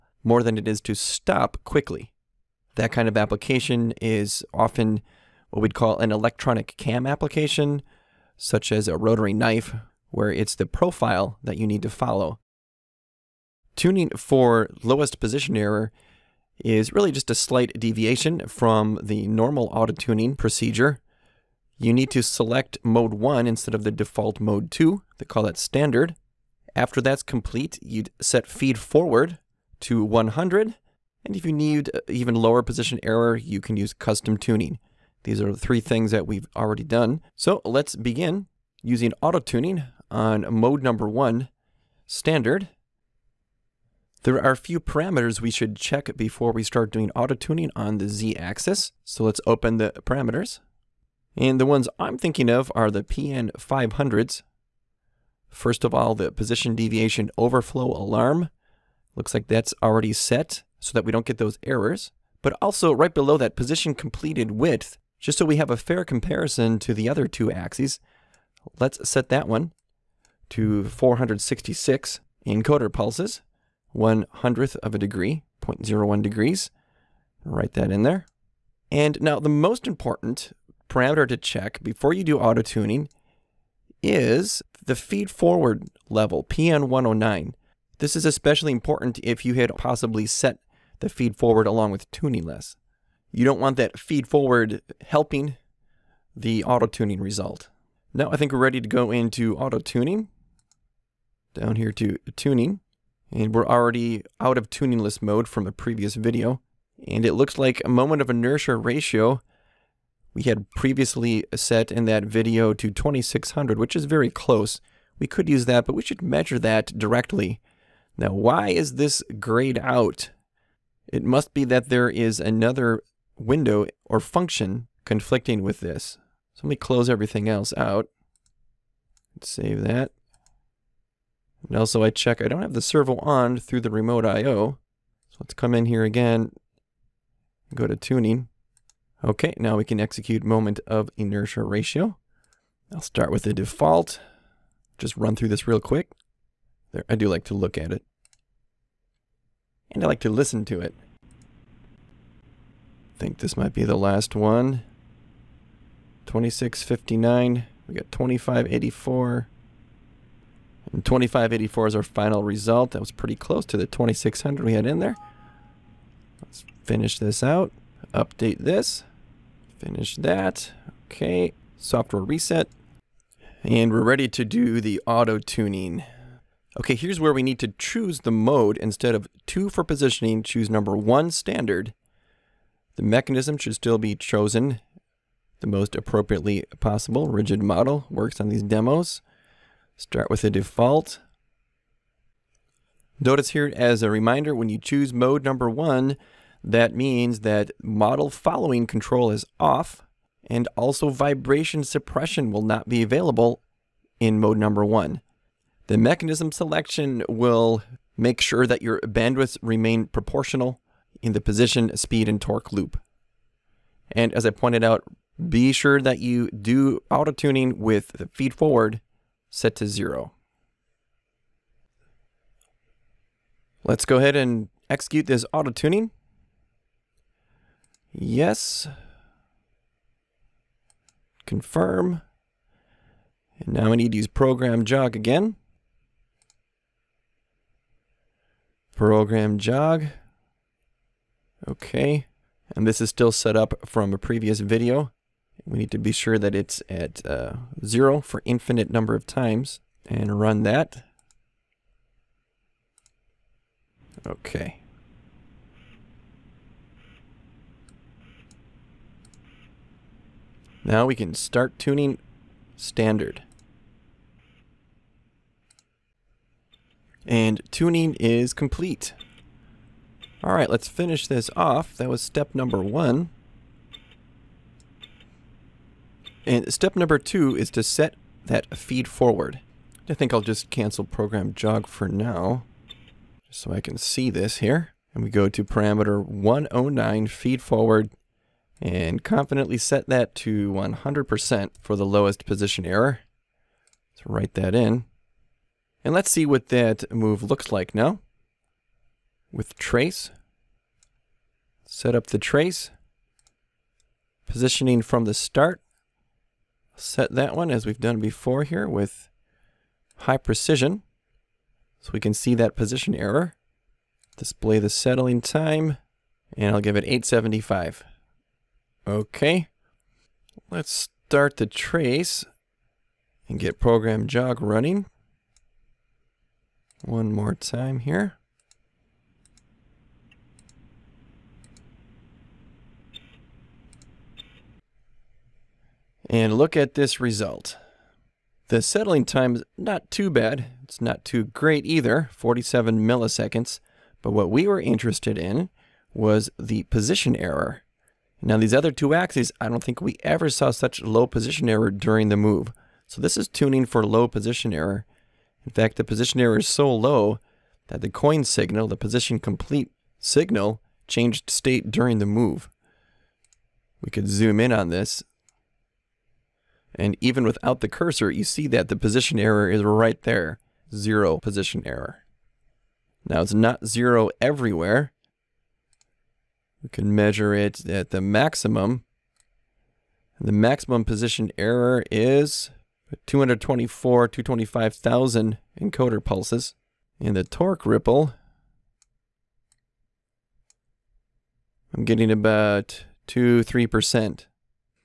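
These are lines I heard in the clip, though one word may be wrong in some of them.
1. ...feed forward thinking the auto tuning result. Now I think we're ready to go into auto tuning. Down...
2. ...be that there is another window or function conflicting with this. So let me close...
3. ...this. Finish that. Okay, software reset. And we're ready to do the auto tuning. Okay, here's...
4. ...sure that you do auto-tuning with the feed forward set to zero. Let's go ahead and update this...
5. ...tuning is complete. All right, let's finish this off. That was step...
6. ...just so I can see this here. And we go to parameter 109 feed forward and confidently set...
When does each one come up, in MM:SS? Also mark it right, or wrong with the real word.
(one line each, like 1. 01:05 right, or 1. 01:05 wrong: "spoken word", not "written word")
1. 01:33 wrong: "helping", not "thinking"
2. 02:01 right
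3. 02:48 right
4. 03:35 wrong: "execute", not "update"
5. 04:27 right
6. 04:43 right.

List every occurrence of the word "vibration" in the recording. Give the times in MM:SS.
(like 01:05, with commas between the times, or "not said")
03:21.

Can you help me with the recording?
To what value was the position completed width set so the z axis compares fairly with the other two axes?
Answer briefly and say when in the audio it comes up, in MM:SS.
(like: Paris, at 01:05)
466 encoder pulses, at 01:10.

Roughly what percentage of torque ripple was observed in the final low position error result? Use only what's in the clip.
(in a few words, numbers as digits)
2-3%.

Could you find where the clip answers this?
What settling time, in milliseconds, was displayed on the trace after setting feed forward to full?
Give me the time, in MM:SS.
05:42.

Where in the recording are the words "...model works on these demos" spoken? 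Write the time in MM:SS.
03:07.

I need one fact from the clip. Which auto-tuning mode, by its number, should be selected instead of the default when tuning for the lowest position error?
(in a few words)
mode 1.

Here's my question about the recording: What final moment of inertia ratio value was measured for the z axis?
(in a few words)
2584.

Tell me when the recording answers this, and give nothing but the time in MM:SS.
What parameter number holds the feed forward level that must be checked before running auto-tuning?
01:26.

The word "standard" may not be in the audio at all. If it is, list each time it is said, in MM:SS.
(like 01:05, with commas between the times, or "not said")
00:25, 00:42, 03:01, 04:22.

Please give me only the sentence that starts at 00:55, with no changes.
First of all, the position deviation overflow alarm.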